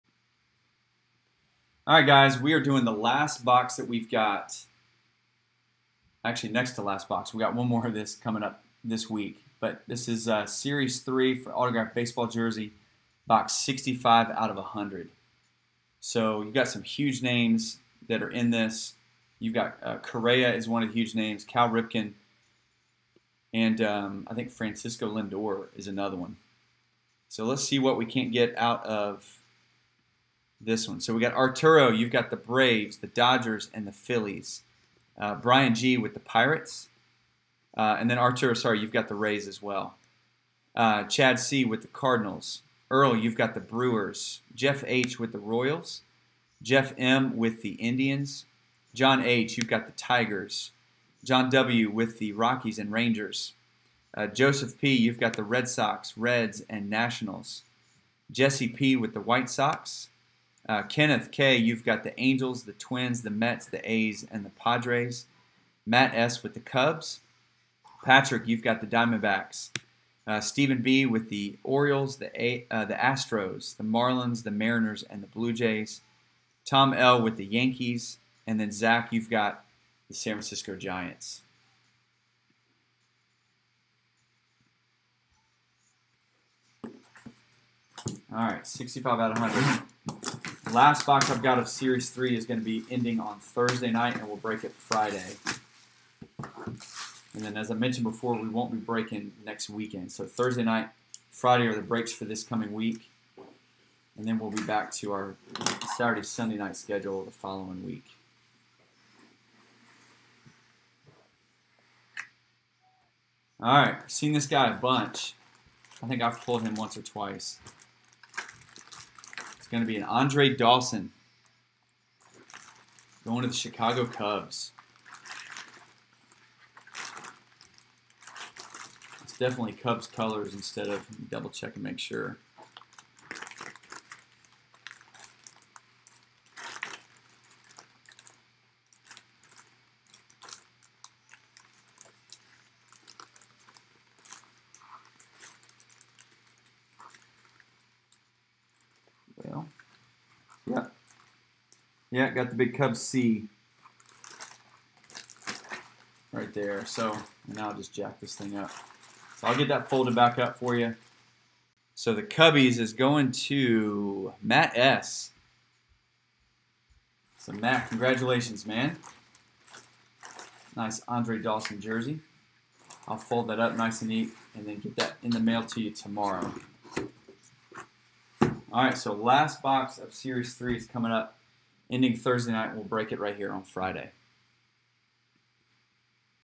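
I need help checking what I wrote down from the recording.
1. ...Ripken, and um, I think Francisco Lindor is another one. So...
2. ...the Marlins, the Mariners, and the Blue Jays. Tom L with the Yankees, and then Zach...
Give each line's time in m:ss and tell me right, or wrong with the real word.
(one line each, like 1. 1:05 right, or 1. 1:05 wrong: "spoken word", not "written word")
1. 0:21 right
2. 1:13 right.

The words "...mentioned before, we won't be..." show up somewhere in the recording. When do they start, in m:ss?
1:37.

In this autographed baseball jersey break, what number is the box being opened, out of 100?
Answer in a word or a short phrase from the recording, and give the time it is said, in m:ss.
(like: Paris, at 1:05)
65, at 0:13.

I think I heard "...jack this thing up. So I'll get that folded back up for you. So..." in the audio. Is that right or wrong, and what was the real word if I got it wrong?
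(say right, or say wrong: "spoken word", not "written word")
right.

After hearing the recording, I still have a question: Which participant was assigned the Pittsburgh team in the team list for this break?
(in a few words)
Brian G.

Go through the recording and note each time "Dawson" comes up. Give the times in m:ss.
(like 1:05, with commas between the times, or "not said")
2:00, 2:51.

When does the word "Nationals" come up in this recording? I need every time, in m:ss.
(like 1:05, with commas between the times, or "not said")
0:56.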